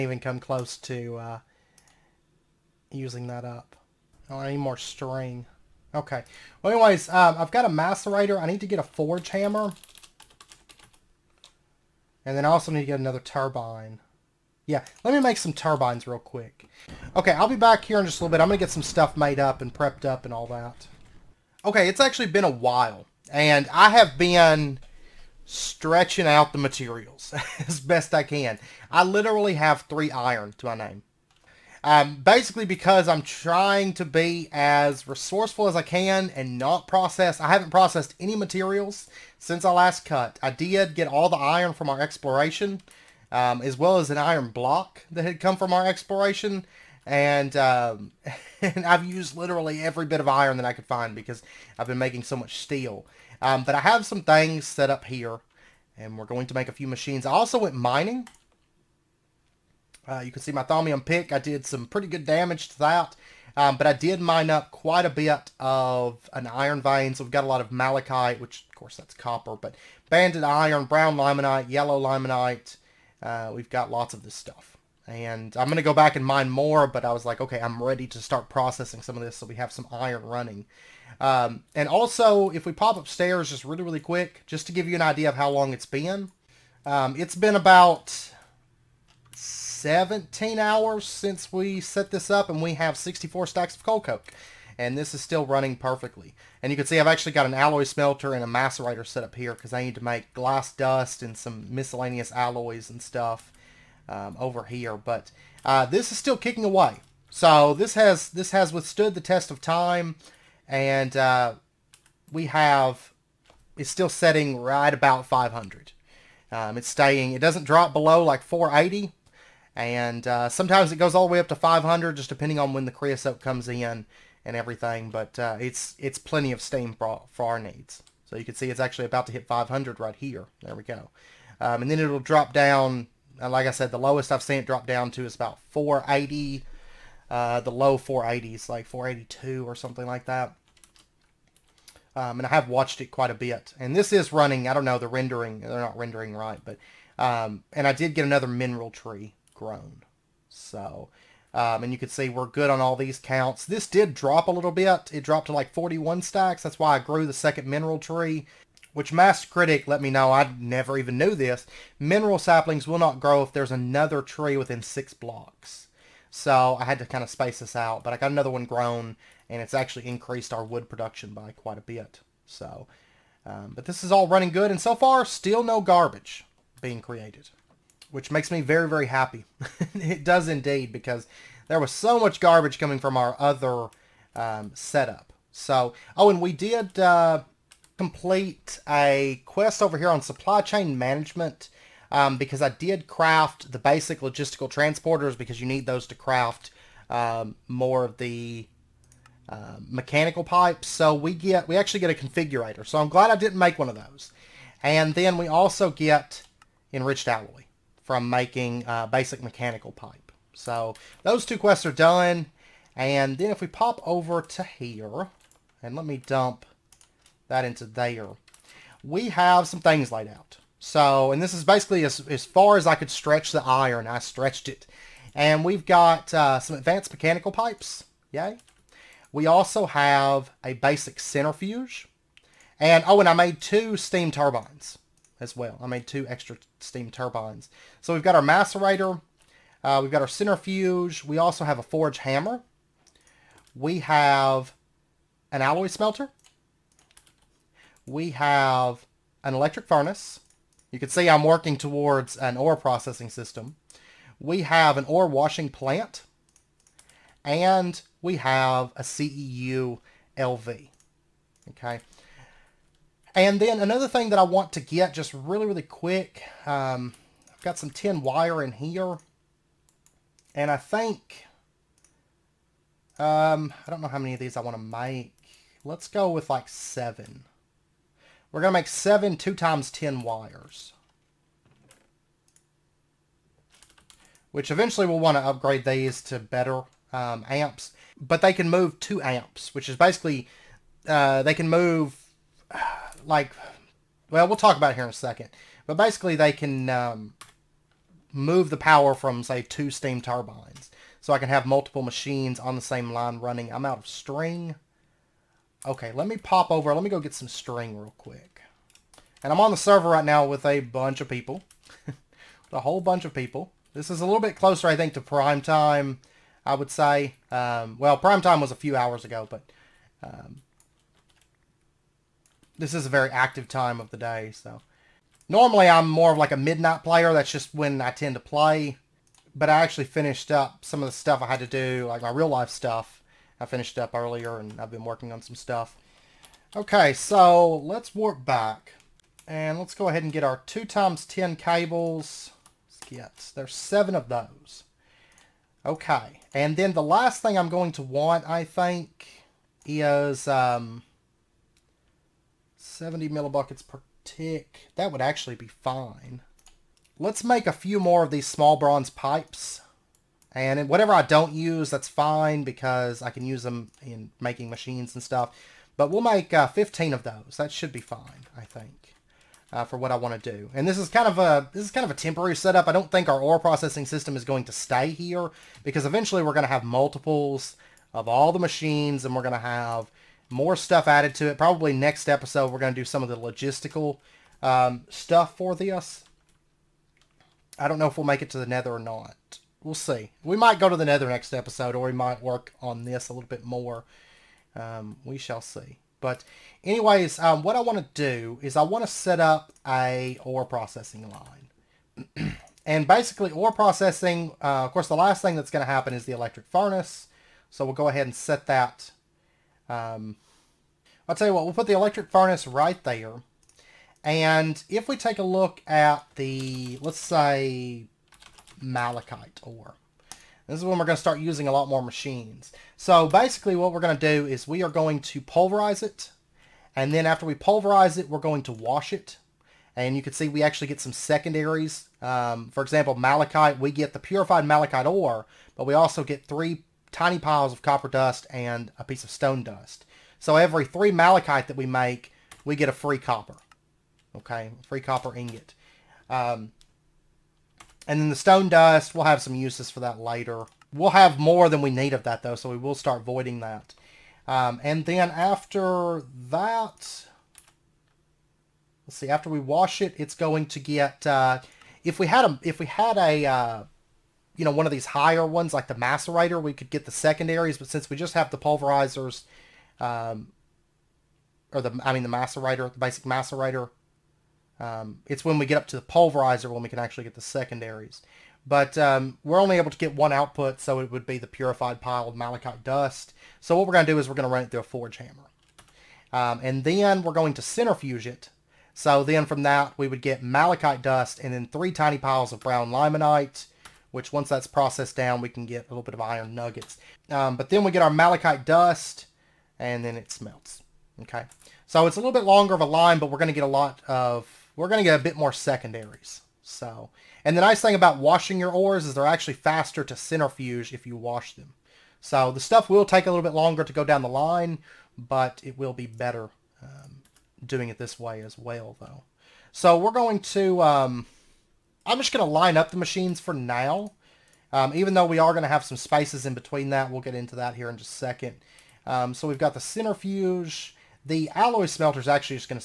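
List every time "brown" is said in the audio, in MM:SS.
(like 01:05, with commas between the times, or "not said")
01:10, 08:12.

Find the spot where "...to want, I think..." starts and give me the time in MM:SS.
05:47.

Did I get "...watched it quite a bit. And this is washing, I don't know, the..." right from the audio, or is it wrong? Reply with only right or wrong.
wrong.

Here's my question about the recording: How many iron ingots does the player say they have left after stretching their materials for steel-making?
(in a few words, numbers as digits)
3.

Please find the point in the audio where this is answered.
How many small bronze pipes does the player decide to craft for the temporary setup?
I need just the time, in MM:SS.
06:06.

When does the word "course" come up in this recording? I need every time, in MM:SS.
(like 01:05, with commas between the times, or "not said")
01:08, 06:44.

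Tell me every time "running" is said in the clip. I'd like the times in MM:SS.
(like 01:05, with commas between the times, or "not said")
01:20, 01:35, 02:24, 02:54, 05:03.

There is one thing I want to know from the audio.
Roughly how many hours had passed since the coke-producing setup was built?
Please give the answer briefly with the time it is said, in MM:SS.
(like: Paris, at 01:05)
17, at 01:29.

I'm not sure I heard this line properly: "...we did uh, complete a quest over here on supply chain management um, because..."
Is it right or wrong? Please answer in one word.
right.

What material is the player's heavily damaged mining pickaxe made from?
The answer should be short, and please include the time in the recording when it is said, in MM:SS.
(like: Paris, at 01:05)
Thaumium, at 01:00.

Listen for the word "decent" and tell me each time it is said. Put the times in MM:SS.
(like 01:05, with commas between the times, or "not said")
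not said.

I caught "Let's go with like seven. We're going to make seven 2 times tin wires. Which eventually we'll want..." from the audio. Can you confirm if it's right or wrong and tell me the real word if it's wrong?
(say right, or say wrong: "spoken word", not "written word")
right.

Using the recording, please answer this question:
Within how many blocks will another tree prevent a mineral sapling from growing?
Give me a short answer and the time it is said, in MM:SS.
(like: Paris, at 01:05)
6, at 02:44.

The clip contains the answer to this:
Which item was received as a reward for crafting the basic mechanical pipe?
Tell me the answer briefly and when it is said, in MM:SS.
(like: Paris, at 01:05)
enriched alloy, at 03:26.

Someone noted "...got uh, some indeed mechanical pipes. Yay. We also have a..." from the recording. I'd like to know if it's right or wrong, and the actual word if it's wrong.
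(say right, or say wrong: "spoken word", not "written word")
wrong: "advanced", not "indeed".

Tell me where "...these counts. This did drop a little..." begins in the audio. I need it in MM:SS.
02:32.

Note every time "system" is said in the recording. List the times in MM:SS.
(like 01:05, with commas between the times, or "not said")
04:13, 06:14.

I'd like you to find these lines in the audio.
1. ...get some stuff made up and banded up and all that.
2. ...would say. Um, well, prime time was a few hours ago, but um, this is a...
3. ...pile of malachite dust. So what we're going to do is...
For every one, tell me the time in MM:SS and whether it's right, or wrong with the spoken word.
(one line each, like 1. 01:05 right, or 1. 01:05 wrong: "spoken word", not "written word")
1. 00:18 wrong: "prepped", not "banded"
2. 05:16 right
3. 08:01 right.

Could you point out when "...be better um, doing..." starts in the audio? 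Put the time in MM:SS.
08:35.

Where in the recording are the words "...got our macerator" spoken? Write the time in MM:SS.
03:58.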